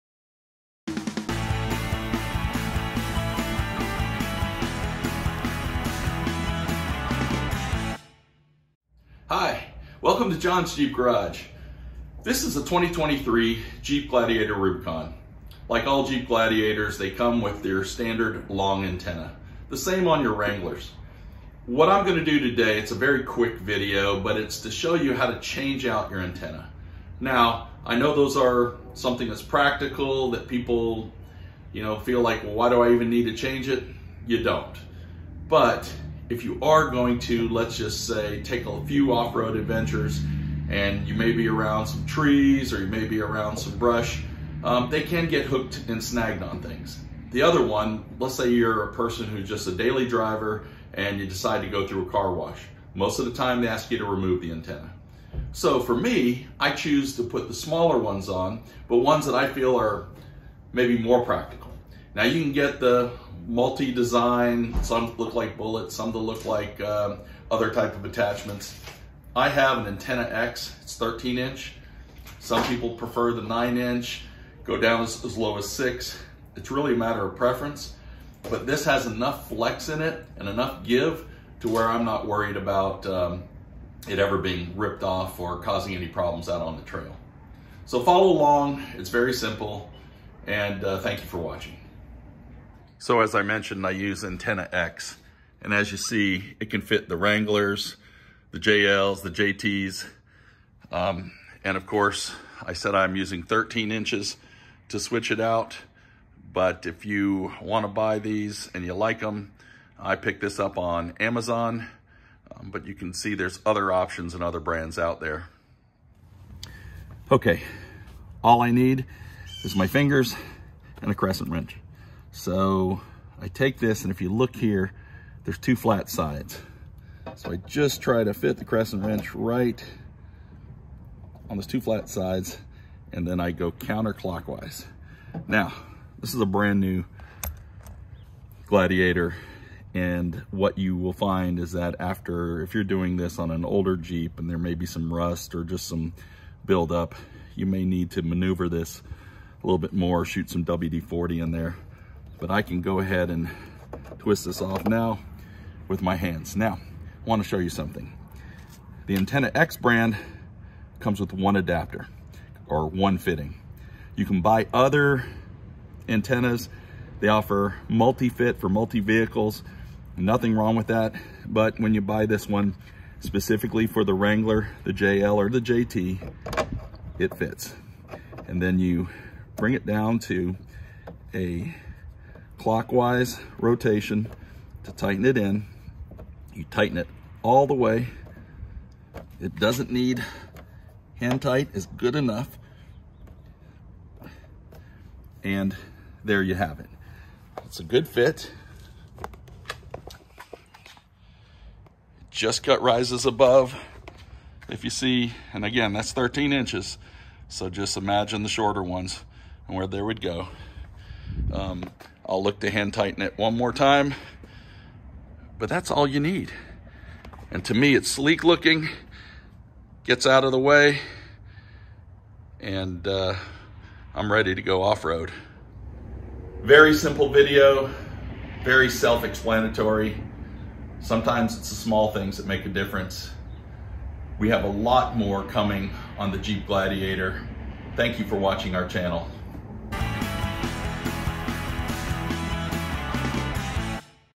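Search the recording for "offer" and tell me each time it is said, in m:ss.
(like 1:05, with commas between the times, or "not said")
2:47.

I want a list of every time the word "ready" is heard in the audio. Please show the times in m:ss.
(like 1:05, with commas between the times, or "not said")
3:44.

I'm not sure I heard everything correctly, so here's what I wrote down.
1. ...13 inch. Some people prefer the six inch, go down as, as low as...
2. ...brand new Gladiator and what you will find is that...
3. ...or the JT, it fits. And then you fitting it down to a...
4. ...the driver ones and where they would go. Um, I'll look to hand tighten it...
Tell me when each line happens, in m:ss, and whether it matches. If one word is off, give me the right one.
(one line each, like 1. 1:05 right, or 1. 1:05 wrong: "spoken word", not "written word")
1. 1:10 wrong: "nine", not "six"
2. 2:16 right
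3. 2:55 wrong: "bring", not "fitting"
4. 3:28 wrong: "shorter", not "driver".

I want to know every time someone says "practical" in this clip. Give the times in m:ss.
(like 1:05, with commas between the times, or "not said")
0:29, 1:01.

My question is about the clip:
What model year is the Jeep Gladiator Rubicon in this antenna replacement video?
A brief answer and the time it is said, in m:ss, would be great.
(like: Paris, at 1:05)
2023, at 0:12.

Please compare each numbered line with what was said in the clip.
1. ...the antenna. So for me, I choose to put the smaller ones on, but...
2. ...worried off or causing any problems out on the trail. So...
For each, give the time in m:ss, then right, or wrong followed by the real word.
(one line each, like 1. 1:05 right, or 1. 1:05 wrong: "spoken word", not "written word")
1. 0:54 right
2. 1:24 wrong: "ripped", not "worried".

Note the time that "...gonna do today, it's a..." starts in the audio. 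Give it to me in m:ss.
0:22.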